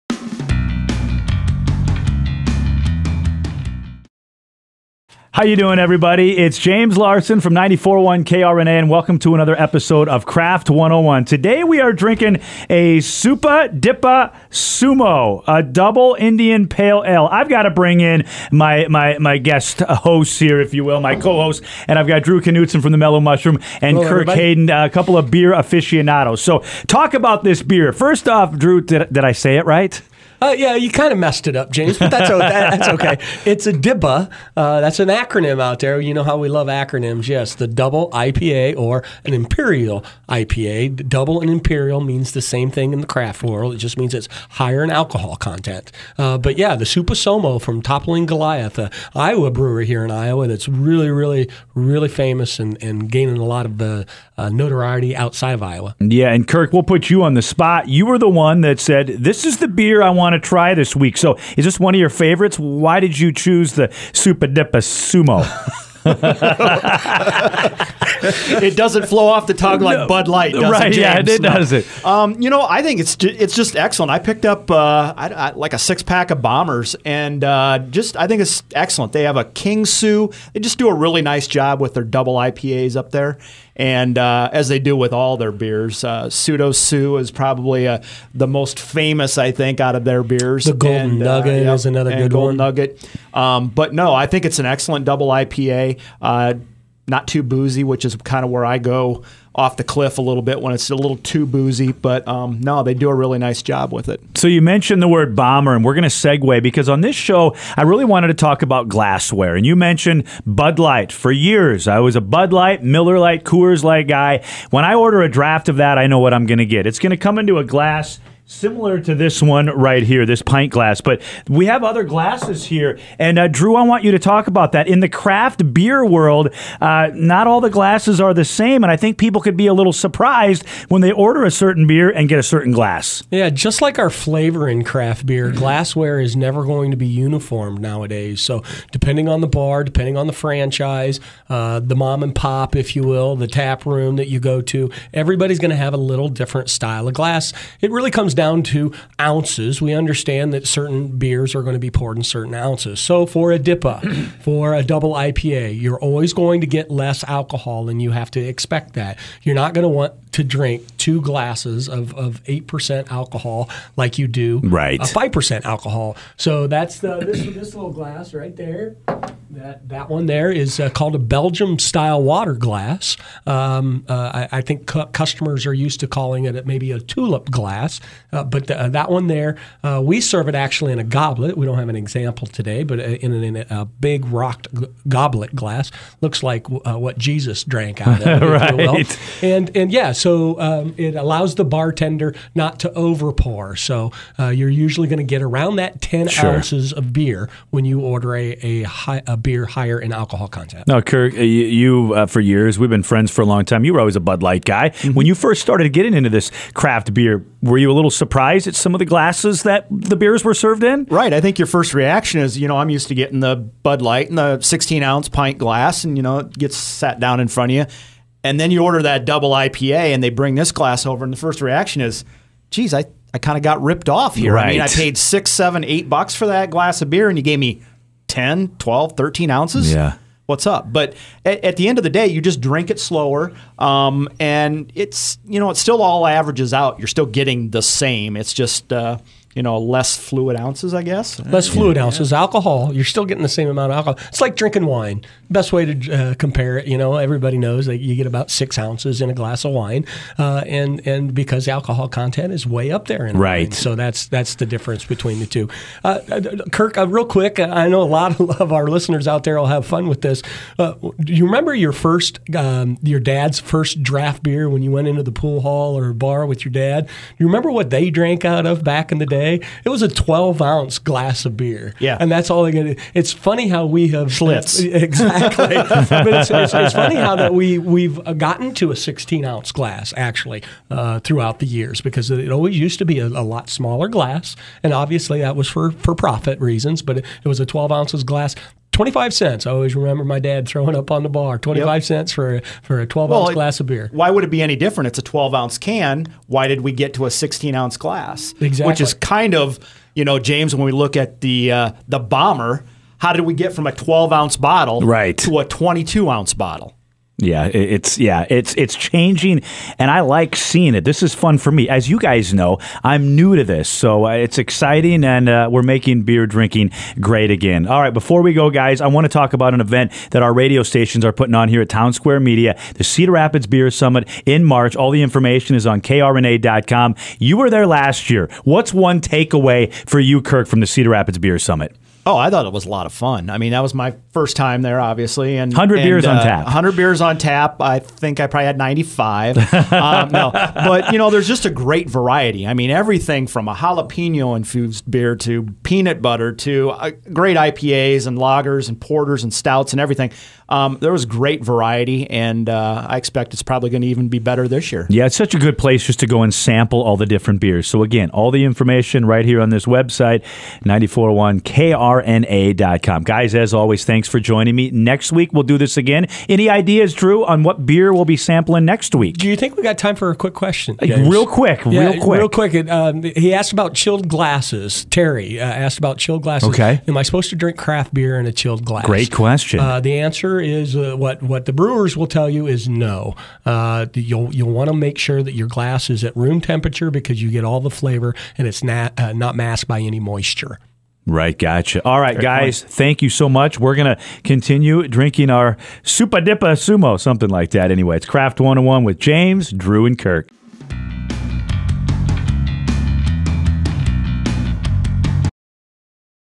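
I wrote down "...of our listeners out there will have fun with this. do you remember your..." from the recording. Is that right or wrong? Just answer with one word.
right.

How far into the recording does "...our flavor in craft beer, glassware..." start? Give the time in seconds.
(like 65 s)
133 s.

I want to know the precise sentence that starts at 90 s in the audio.
The Golden and, uh, Nugget yeah, is another good Golden one.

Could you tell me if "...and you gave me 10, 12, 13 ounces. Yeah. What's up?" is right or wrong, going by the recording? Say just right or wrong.
right.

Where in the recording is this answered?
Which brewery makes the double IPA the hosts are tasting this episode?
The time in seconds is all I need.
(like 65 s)
47 s.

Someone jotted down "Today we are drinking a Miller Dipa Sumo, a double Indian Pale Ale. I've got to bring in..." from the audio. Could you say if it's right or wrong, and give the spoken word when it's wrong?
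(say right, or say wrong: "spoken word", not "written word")
wrong: "Supa", not "Miller".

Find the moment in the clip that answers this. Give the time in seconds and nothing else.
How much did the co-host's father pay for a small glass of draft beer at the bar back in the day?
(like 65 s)
289 s.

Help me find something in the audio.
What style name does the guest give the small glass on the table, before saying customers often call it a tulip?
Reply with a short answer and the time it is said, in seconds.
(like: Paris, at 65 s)
Belgium style water glass, at 171 s.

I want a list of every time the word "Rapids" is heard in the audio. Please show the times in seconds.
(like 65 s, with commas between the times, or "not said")
323 s, 331 s.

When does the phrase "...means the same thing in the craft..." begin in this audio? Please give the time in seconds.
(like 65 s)
42 s.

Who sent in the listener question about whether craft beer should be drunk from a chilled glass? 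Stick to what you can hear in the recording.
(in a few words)
Terry.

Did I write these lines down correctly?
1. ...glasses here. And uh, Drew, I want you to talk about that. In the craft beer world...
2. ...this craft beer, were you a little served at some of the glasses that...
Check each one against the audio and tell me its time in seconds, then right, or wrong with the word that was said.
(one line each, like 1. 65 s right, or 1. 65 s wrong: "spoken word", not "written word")
1. 122 s right
2. 206 s wrong: "surprised", not "served".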